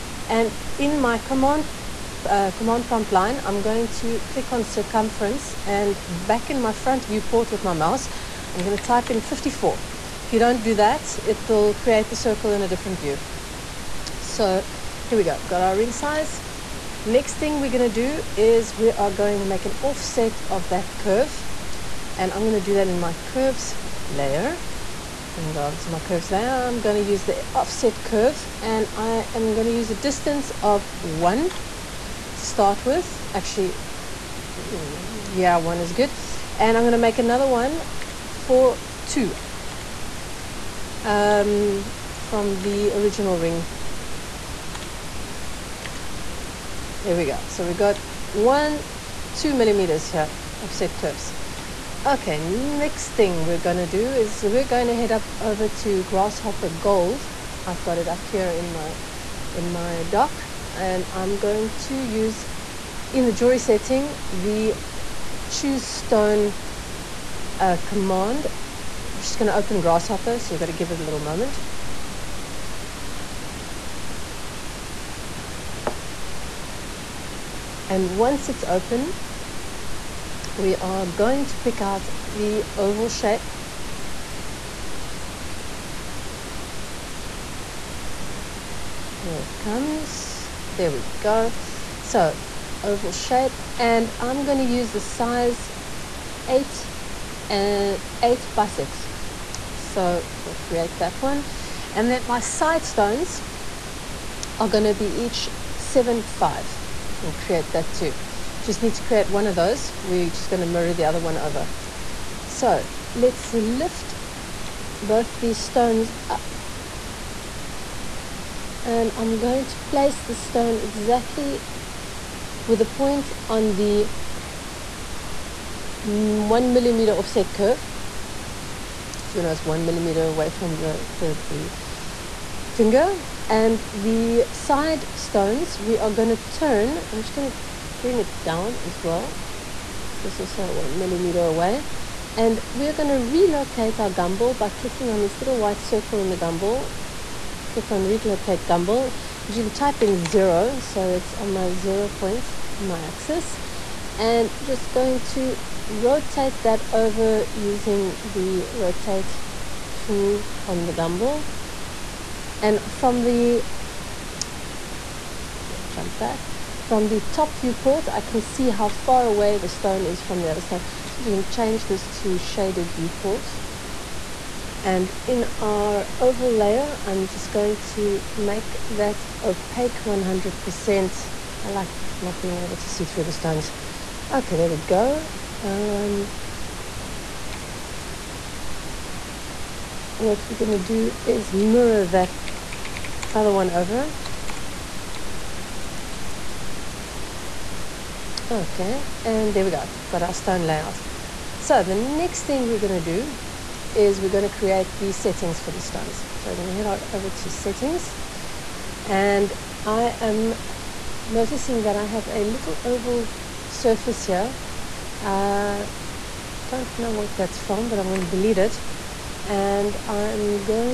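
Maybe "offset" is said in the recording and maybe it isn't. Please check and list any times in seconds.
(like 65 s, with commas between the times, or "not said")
19 s, 27 s, 50 s, 127 s.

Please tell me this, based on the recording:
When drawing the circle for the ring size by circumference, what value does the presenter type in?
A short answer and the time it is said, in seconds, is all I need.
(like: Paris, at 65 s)
54, at 9 s.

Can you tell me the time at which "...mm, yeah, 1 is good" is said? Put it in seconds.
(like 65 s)
34 s.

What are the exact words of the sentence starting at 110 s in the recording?
We're just going to mirror the other one over.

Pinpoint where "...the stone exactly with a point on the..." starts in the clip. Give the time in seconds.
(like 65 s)
120 s.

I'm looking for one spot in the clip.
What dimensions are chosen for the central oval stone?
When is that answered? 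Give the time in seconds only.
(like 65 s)
98 s.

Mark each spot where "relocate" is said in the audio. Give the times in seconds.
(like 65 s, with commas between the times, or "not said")
143 s, 148 s.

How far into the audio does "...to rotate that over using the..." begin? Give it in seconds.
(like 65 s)
155 s.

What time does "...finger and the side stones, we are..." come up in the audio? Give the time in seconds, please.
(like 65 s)
132 s.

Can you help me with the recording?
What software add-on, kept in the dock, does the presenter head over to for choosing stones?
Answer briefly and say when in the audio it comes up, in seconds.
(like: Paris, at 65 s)
Grasshopper Gold, at 56 s.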